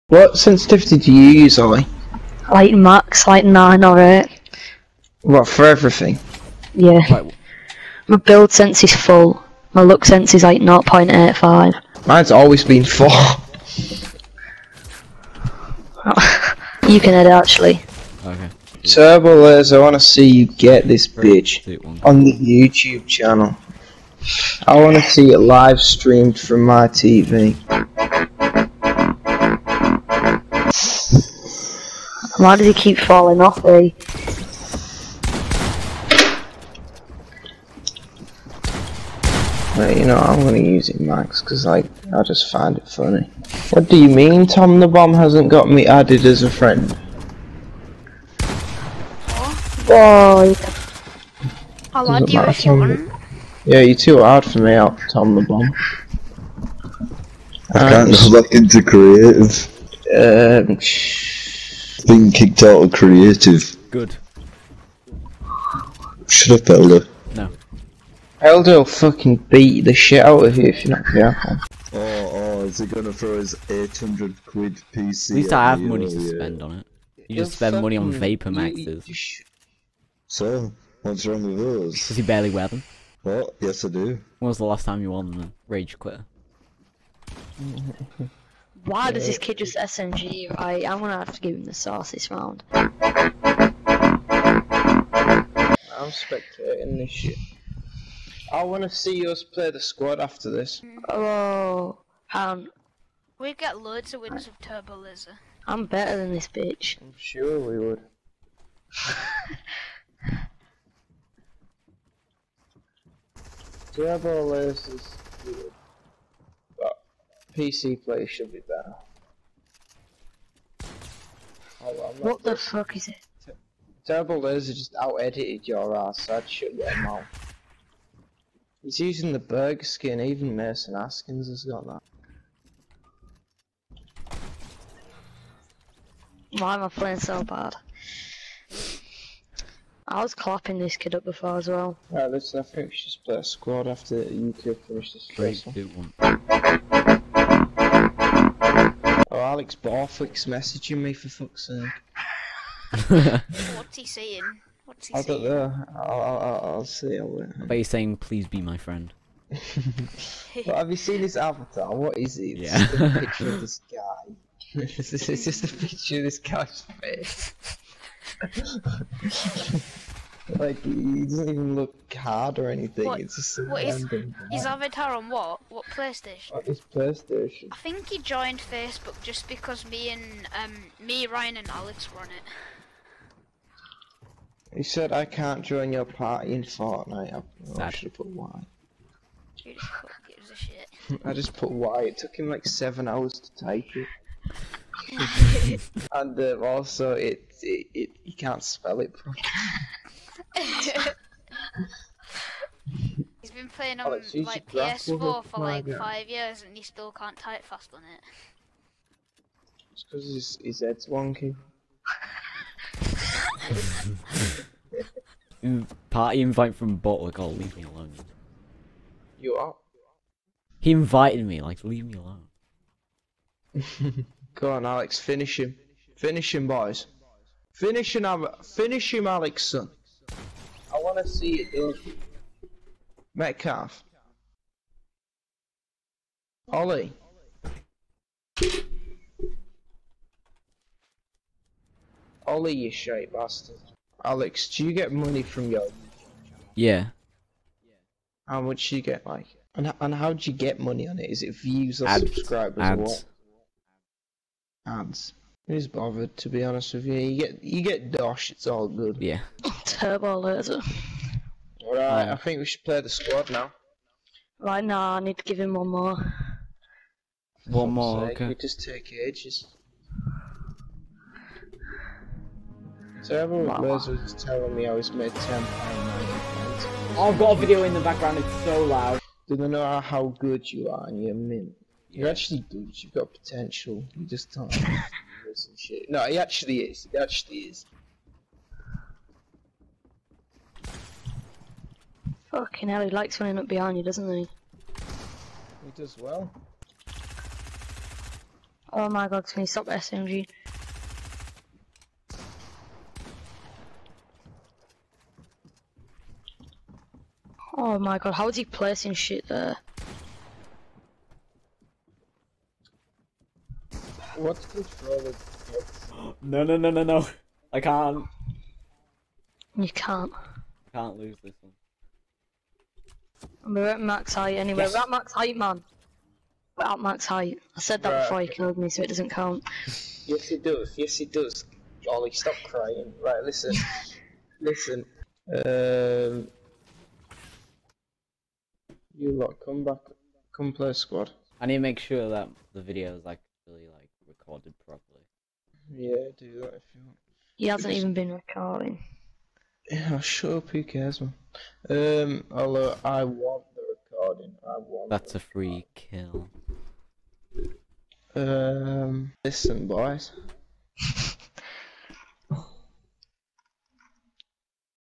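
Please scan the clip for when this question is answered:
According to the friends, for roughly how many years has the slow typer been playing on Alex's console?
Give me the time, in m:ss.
3:25.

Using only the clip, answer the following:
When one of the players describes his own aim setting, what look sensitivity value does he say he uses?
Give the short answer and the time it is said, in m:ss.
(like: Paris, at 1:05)
0.85, at 0:10.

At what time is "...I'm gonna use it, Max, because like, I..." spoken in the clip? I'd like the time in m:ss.
0:40.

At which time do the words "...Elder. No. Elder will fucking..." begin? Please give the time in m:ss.
1:06.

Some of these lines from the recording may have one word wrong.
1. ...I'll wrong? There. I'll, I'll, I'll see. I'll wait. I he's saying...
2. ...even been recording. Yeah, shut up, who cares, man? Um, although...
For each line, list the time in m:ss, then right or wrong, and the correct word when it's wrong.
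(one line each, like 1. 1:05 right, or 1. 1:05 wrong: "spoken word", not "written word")
1. 2:35 wrong: "saying", not "wrong"
2. 5:47 right.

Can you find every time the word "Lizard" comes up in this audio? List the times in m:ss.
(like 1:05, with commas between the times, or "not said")
1:44, 1:54.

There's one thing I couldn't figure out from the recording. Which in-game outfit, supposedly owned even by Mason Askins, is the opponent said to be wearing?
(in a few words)
burger skin.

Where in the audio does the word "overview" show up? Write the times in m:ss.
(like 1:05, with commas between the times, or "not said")
not said.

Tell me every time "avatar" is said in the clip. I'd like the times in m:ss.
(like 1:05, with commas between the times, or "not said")
2:41, 2:54.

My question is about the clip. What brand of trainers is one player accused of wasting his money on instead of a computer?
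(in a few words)
Vapor Maxes.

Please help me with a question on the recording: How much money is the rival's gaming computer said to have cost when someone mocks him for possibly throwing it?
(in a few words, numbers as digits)
800 quid.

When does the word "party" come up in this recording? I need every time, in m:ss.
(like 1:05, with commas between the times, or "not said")
3:06, 3:36.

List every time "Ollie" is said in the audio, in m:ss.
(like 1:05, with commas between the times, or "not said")
0:01, 3:56, 4:02, 5:32.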